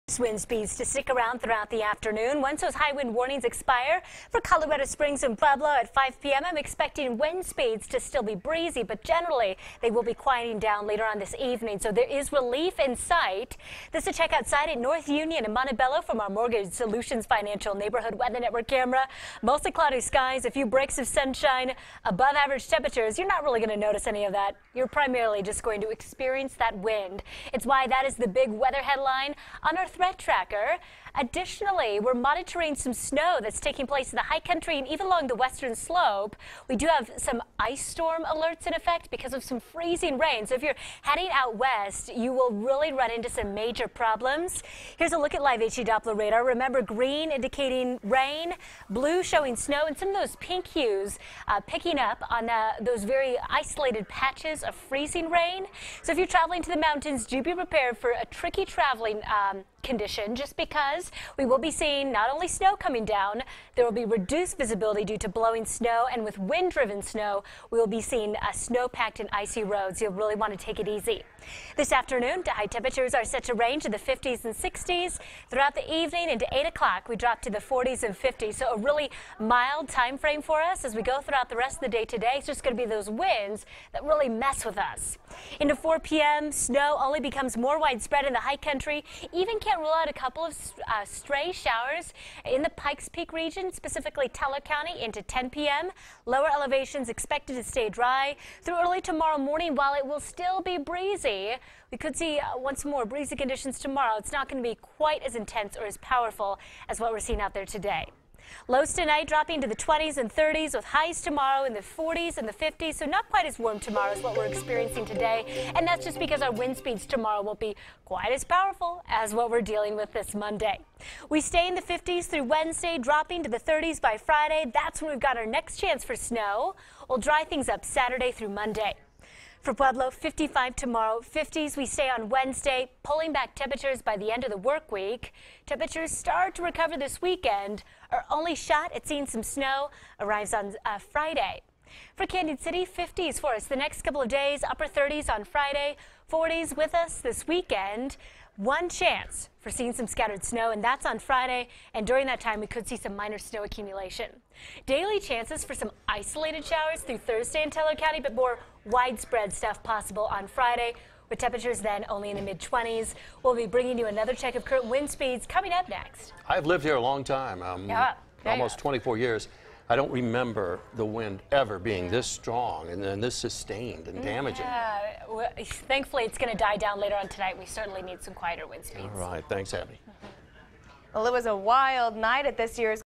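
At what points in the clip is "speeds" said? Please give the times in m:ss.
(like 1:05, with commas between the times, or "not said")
0:00, 0:07, 1:56, 2:45, 2:58.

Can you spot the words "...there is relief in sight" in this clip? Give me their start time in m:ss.
0:11.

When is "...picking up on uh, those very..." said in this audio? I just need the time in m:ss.
0:51.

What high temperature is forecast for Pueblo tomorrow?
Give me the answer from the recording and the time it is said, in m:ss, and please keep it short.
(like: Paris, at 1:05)
55, at 2:10.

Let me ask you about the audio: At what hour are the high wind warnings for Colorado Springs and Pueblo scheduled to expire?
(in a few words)
5 p.m.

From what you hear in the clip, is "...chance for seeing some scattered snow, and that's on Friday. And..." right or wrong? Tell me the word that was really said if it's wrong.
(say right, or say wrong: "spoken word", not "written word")
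right.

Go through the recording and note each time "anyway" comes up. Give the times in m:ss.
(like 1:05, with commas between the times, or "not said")
not said.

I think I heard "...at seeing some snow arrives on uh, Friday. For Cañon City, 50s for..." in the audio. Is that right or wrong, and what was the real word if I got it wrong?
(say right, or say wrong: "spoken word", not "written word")
right.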